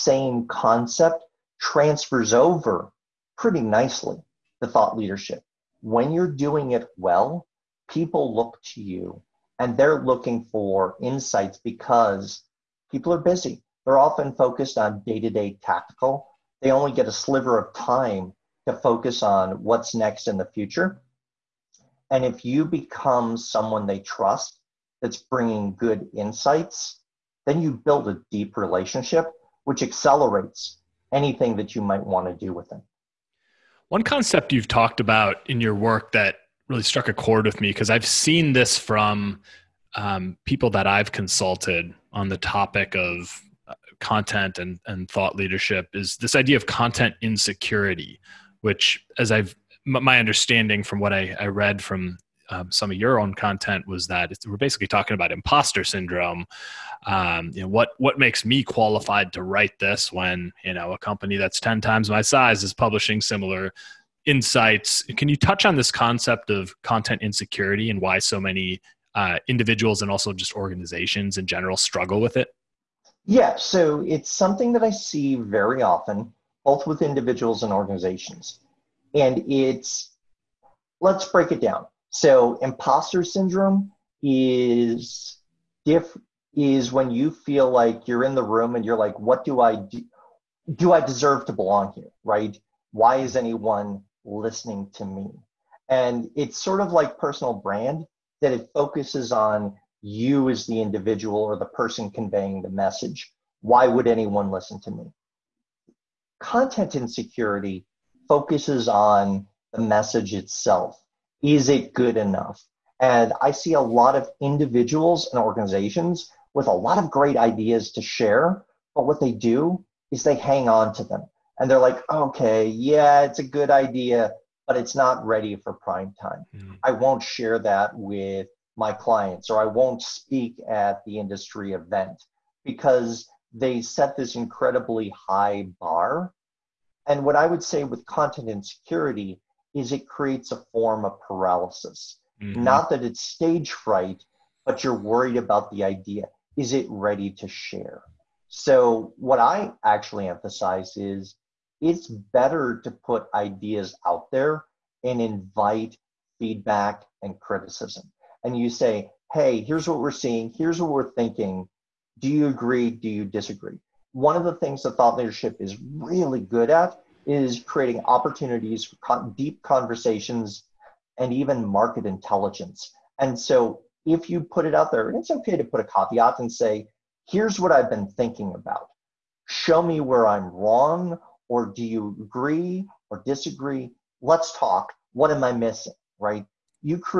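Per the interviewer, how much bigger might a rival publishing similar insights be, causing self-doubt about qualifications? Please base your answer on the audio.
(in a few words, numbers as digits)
ten times.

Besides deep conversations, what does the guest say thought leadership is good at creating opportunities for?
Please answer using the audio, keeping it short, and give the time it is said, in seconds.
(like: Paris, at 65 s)
market intelligence, at 171 s.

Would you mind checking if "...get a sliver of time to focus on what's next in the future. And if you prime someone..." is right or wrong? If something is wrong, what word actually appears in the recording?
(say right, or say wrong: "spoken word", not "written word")
wrong: "become", not "prime".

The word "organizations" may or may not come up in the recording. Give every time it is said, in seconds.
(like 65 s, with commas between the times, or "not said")
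70 s, 77 s, 115 s.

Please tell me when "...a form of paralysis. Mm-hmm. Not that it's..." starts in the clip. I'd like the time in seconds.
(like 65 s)
140 s.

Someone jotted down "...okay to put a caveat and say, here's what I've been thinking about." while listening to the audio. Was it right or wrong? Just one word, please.
right.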